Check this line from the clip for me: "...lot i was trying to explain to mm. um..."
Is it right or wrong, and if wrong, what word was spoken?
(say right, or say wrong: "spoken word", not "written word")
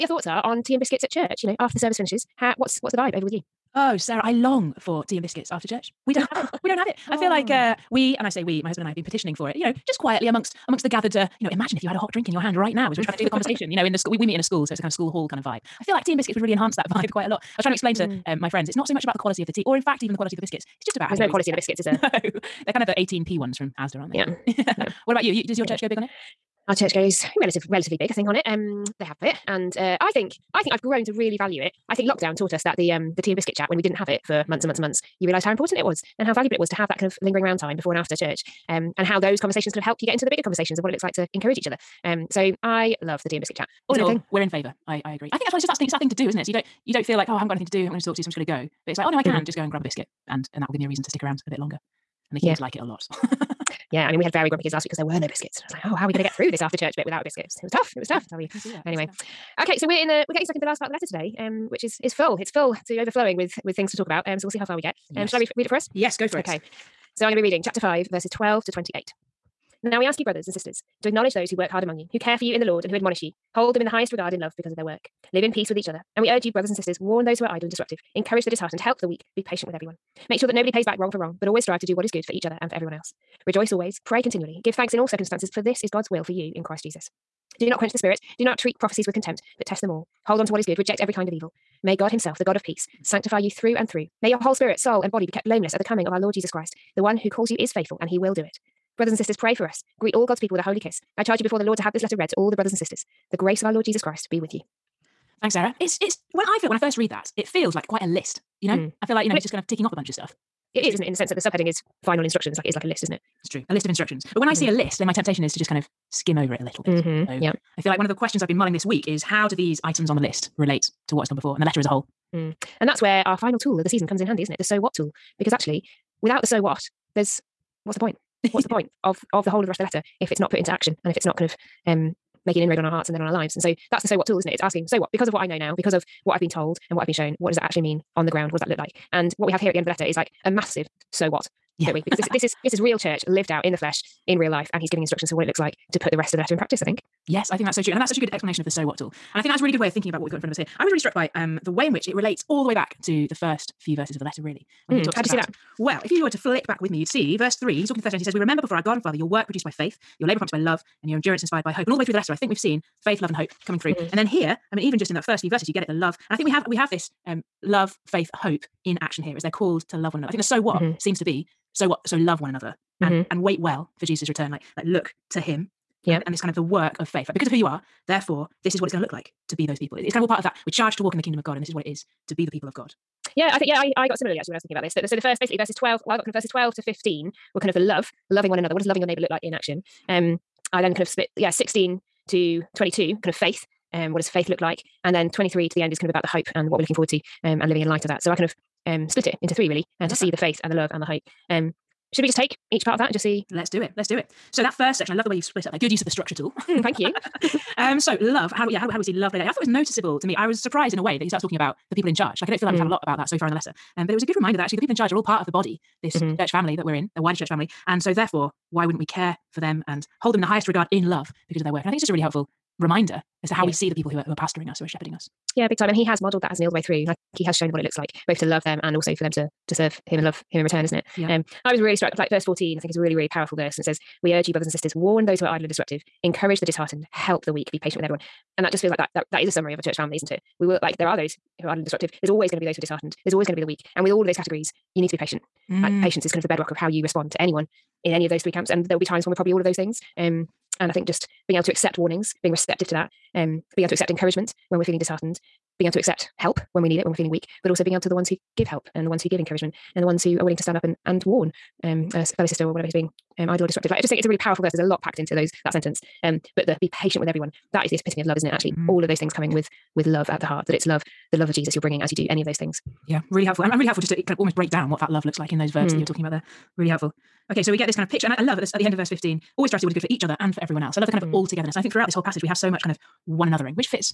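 right.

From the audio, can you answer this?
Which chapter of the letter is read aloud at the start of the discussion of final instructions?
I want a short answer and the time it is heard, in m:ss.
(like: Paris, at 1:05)
Chapter 5, at 1:07.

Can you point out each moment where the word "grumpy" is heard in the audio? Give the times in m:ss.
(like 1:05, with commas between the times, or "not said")
0:54.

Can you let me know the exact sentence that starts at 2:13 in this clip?
And so that's the so what tool, isn't it?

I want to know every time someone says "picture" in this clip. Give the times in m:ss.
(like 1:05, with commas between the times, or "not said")
4:38.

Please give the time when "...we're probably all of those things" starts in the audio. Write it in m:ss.
4:09.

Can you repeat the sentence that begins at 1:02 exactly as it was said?
It's full to overflowing with with things to talk about.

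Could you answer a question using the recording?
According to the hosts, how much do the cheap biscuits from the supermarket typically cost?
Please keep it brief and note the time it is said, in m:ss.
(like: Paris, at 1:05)
18p, at 0:22.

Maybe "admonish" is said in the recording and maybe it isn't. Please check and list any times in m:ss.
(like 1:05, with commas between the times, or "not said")
1:12.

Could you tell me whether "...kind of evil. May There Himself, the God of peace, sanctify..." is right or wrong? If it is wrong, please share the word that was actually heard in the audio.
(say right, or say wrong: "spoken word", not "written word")
wrong: "God", not "There".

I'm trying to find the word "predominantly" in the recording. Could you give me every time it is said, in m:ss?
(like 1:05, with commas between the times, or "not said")
not said.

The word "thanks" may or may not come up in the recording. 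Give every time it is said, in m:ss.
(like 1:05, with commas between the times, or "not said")
1:24, 1:45, 3:26.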